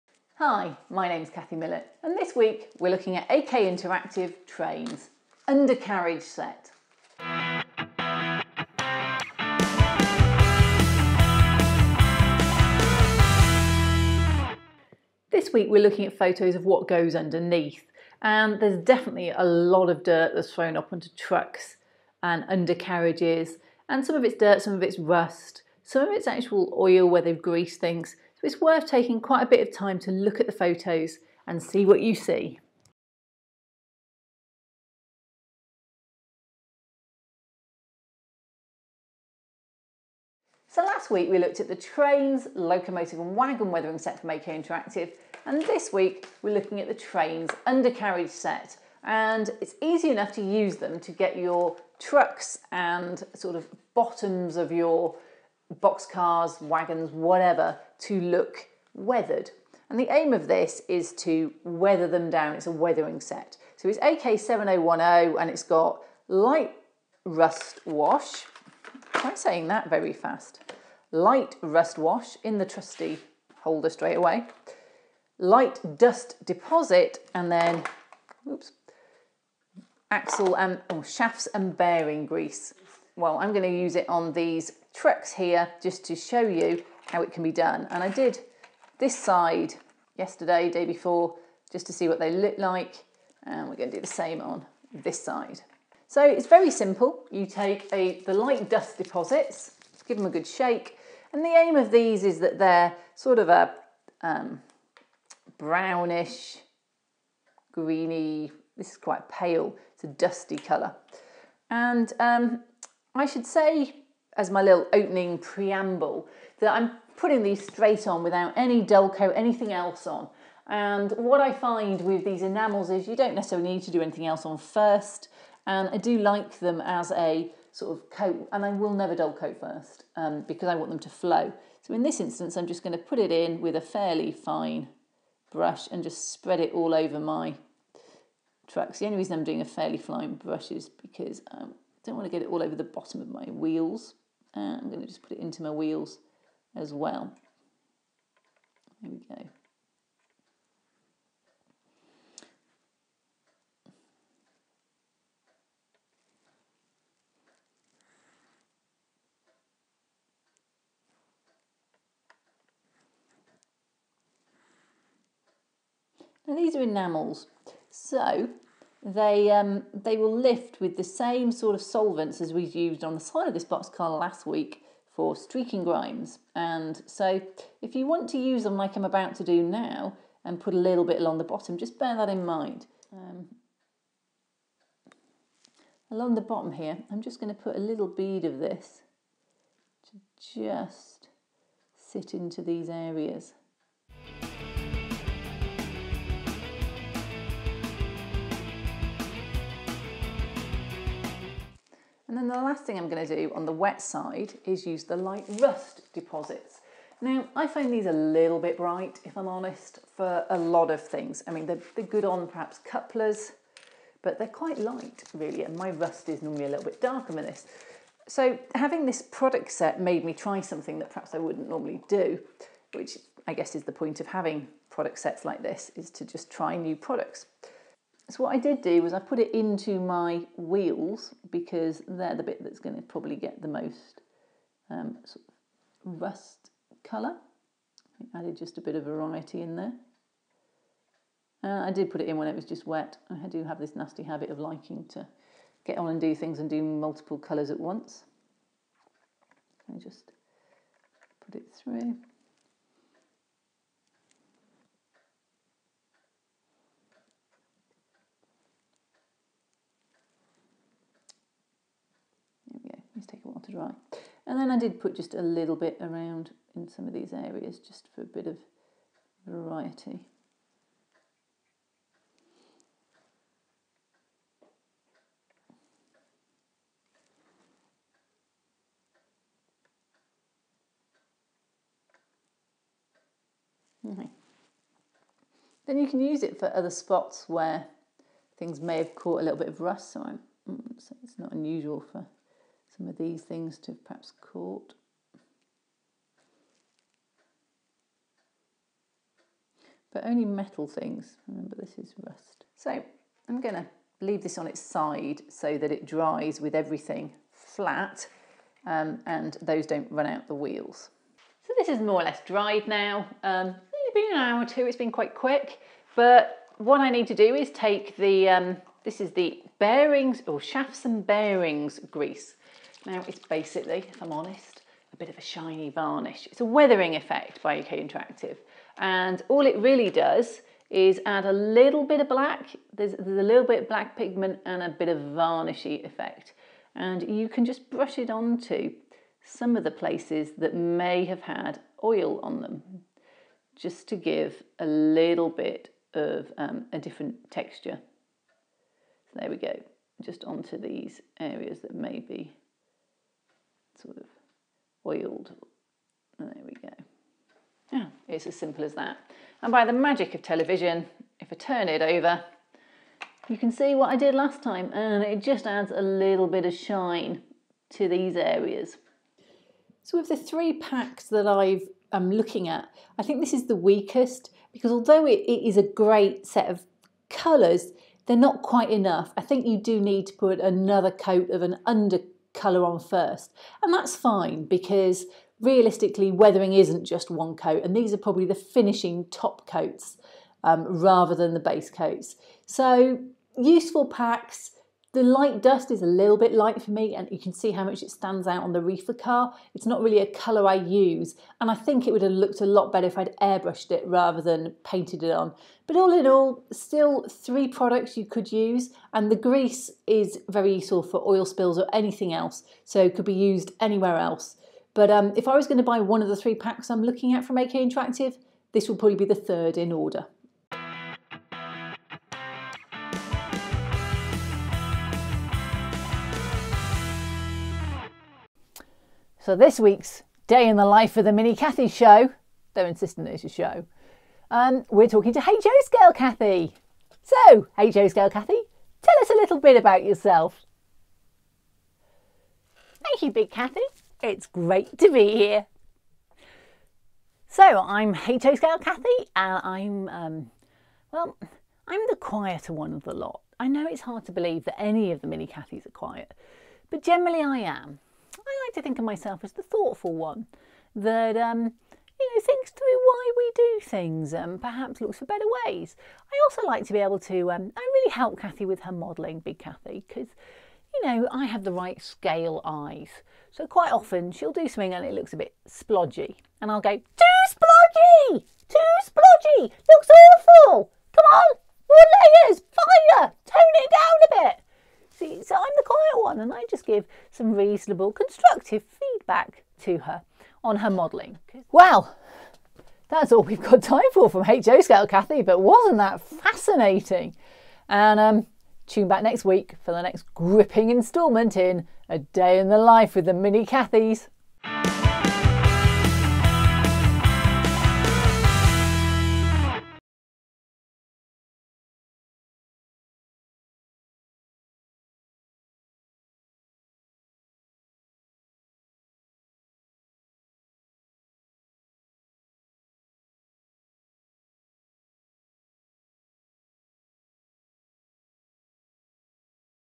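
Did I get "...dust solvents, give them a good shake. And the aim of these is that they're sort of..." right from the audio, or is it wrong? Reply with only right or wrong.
wrong.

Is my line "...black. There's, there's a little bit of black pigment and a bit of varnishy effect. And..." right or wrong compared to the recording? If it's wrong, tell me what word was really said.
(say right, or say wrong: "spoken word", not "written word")
right.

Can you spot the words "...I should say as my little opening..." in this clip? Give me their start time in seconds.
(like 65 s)
113 s.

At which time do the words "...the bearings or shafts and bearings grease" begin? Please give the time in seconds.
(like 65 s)
319 s.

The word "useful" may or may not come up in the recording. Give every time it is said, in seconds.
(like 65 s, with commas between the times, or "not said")
393 s, 410 s.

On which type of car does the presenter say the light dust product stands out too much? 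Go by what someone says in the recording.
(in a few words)
Reefer car.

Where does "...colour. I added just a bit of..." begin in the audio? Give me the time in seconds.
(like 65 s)
237 s.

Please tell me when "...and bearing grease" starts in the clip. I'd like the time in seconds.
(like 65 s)
81 s.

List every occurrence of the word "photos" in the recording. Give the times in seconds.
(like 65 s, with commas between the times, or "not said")
16 s, 30 s.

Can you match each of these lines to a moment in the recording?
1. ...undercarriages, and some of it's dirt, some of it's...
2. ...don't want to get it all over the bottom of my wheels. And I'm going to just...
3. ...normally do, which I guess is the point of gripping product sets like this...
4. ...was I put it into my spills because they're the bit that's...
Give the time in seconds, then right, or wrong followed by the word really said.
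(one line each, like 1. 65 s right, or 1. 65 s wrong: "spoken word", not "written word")
1. 22 s right
2. 142 s right
3. 221 s wrong: "having", not "gripping"
4. 229 s wrong: "wheels", not "spills".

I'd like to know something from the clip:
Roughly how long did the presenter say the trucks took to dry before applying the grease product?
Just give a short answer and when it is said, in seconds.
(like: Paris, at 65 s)
An hour or two, at 314 s.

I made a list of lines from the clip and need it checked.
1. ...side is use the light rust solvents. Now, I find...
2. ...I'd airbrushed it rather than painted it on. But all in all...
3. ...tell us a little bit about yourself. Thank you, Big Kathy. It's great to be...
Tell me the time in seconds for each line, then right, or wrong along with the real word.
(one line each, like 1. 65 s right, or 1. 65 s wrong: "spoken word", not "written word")
1. 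204 s wrong: "deposits", not "solvents"
2. 403 s right
3. 439 s right.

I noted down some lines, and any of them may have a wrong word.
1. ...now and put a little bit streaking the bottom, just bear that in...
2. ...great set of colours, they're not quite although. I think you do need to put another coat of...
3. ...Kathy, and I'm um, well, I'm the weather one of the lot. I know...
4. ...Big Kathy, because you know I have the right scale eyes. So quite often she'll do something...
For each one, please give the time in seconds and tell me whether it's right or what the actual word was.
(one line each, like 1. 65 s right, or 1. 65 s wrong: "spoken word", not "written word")
1. 179 s wrong: "along", not "streaking"
2. 375 s wrong: "enough", not "although"
3. 448 s wrong: "quieter", not "weather"
4. 469 s right.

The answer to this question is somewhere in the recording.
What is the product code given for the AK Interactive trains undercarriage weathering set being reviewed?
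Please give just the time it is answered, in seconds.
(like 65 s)
63 s.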